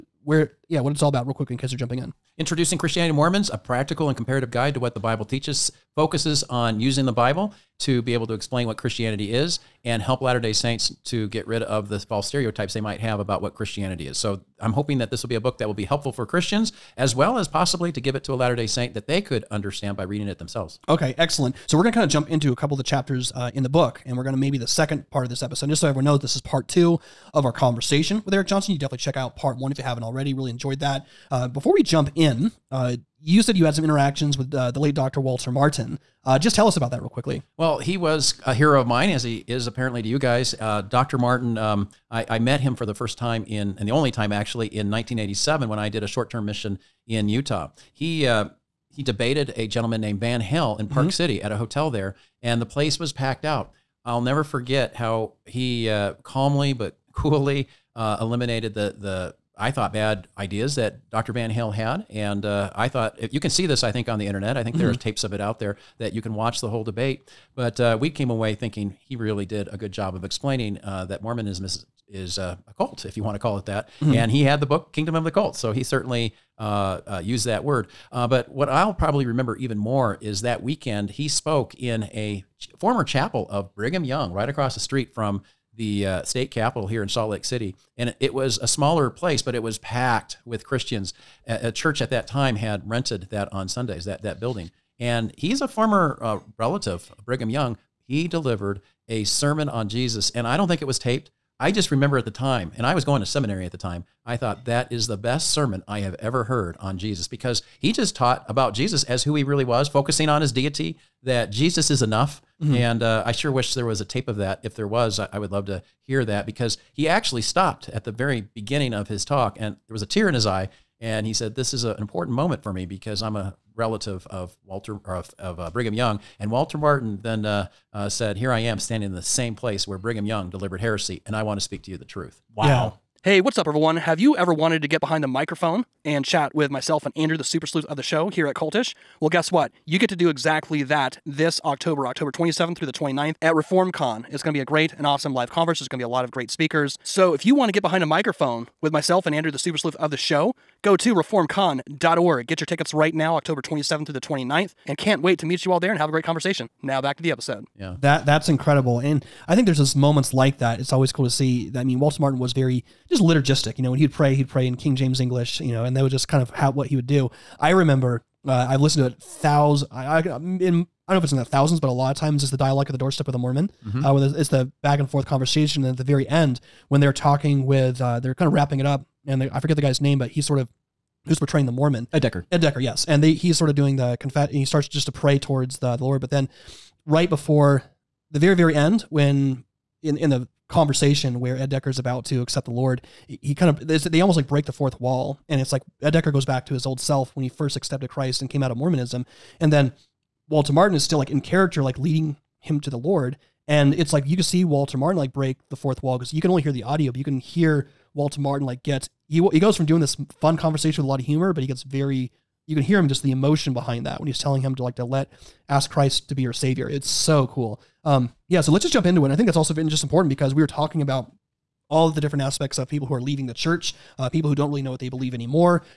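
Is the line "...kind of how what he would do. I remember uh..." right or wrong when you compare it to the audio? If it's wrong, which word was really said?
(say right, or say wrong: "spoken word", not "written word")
right.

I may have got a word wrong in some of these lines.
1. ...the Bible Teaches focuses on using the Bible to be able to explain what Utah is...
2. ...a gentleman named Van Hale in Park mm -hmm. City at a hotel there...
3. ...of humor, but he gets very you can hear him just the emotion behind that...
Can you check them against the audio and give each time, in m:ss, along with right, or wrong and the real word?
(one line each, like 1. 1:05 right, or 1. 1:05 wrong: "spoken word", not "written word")
1. 0:04 wrong: "Christianity", not "Utah"
2. 0:49 right
3. 3:31 right.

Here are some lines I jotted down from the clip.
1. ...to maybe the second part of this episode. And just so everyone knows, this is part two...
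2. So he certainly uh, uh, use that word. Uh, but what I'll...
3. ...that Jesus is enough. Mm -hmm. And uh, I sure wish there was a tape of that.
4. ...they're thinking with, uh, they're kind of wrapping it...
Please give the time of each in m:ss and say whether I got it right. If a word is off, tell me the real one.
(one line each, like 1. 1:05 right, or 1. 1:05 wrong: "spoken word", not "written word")
1. 0:24 right
2. 1:15 right
3. 1:51 right
4. 2:57 wrong: "talking", not "thinking".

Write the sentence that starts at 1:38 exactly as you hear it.
He delivered a sermon on Jesus, and I don't think it was taped.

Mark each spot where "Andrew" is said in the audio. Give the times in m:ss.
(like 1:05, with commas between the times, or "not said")
2:17, 2:29.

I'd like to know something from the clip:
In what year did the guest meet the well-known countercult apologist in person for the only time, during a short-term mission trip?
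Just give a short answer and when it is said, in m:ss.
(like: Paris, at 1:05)
1987, at 0:44.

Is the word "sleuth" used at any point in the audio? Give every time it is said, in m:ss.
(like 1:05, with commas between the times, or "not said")
2:17, 2:29.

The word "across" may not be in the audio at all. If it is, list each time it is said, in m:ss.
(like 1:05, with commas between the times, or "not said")
1:24.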